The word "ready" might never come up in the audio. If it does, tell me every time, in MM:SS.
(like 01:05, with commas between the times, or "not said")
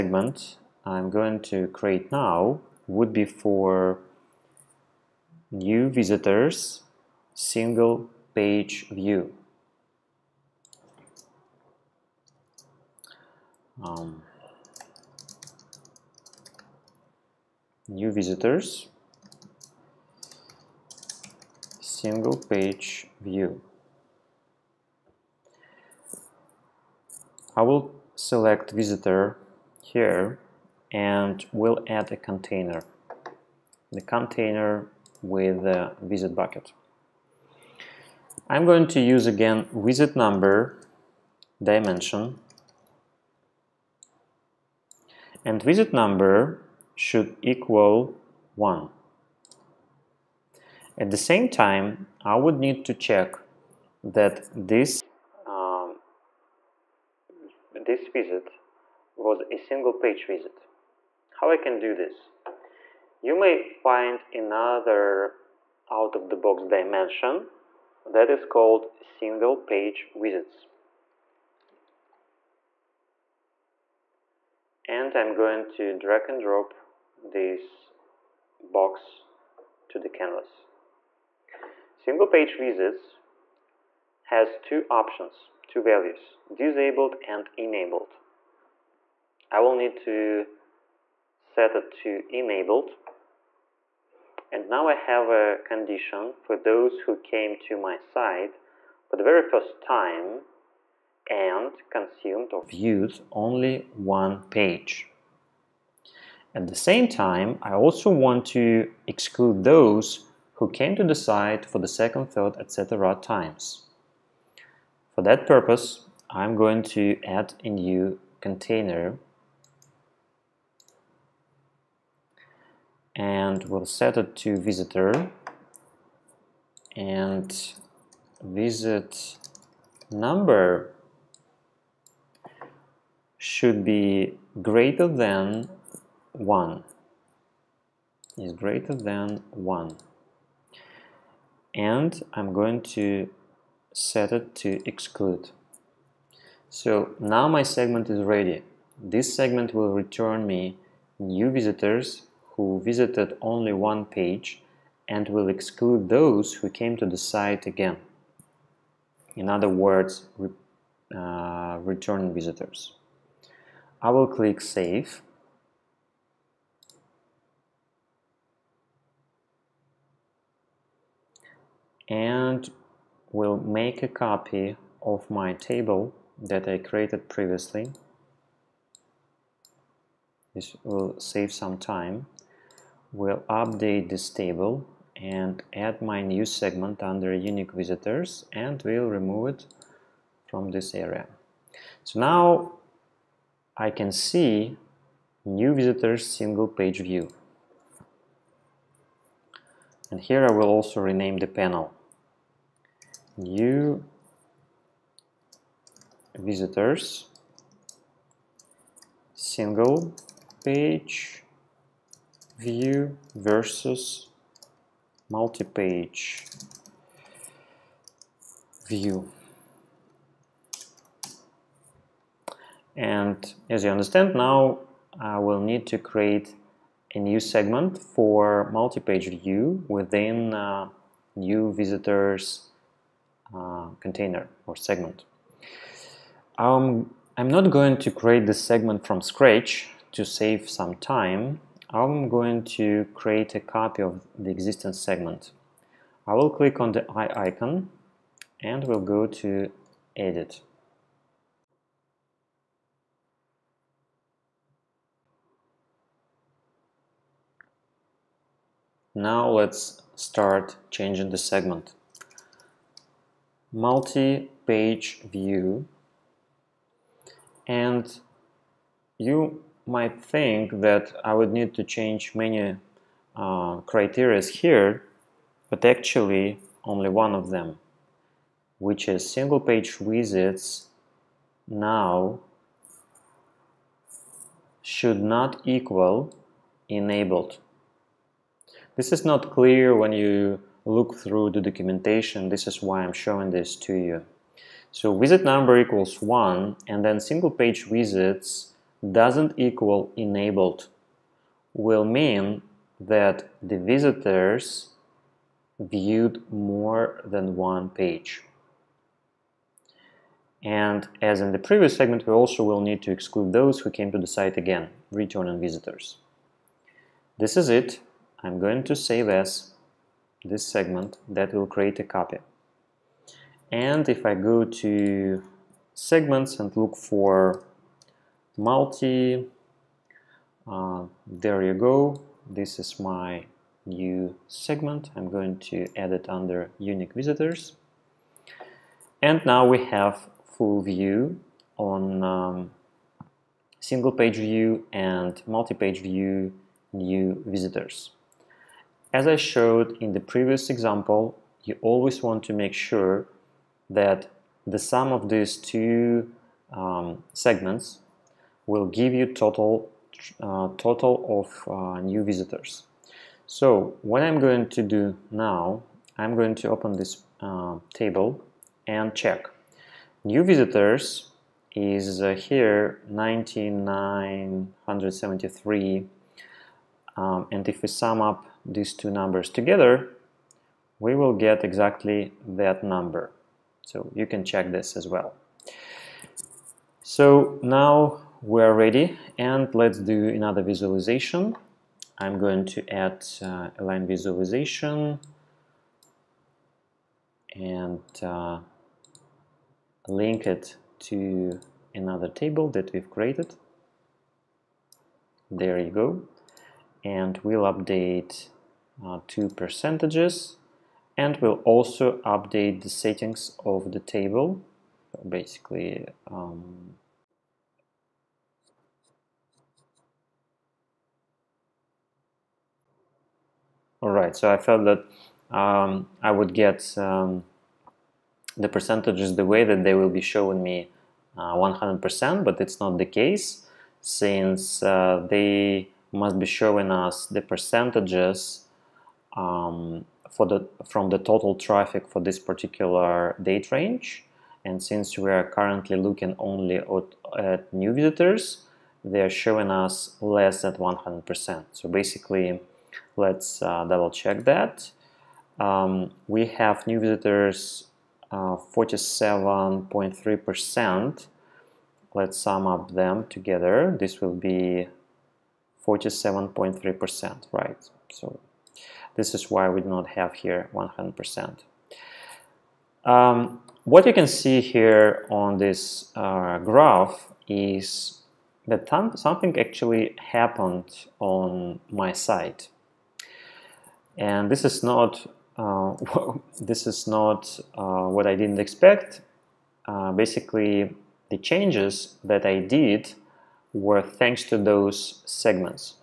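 02:28, 06:28.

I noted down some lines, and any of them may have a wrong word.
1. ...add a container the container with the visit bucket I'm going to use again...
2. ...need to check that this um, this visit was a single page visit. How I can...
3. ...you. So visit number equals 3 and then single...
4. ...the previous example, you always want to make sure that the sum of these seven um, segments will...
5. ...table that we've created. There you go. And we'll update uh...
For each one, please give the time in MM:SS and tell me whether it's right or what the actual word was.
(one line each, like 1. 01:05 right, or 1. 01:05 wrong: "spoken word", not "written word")
1. 00:31 right
2. 00:52 right
3. 04:53 wrong: "1", not "3"
4. 05:50 wrong: "two", not "seven"
5. 06:42 right.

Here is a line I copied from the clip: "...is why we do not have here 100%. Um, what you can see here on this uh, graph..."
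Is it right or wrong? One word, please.
right.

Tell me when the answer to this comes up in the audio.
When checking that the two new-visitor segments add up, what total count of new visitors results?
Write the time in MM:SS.
06:13.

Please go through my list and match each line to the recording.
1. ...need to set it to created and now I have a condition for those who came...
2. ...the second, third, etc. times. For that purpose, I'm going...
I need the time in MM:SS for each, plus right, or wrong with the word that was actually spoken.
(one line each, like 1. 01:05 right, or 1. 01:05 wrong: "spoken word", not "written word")
1. 01:29 wrong: "enabled", not "created"
2. 01:51 right.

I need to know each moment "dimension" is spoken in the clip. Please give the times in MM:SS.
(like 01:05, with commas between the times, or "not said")
00:41, 01:06.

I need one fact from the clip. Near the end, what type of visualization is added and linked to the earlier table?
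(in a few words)
line visualization.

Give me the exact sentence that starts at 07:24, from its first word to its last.
And since we are currently looking only at, at new visitors, they are showing us less than 100%.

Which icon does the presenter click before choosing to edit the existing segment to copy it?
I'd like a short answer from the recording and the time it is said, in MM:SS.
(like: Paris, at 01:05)
eye icon, at 04:07.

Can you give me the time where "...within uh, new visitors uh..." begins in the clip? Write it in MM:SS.
03:49.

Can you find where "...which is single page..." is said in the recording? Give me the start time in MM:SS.
04:38.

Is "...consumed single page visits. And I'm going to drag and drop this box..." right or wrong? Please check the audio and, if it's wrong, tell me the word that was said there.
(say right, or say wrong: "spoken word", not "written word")
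wrong: "called", not "consumed".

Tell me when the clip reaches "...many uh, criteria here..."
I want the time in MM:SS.
04:32.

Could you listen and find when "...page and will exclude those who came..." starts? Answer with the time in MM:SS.
02:34.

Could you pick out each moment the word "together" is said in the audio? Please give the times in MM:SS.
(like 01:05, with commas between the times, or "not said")
06:19, 07:43.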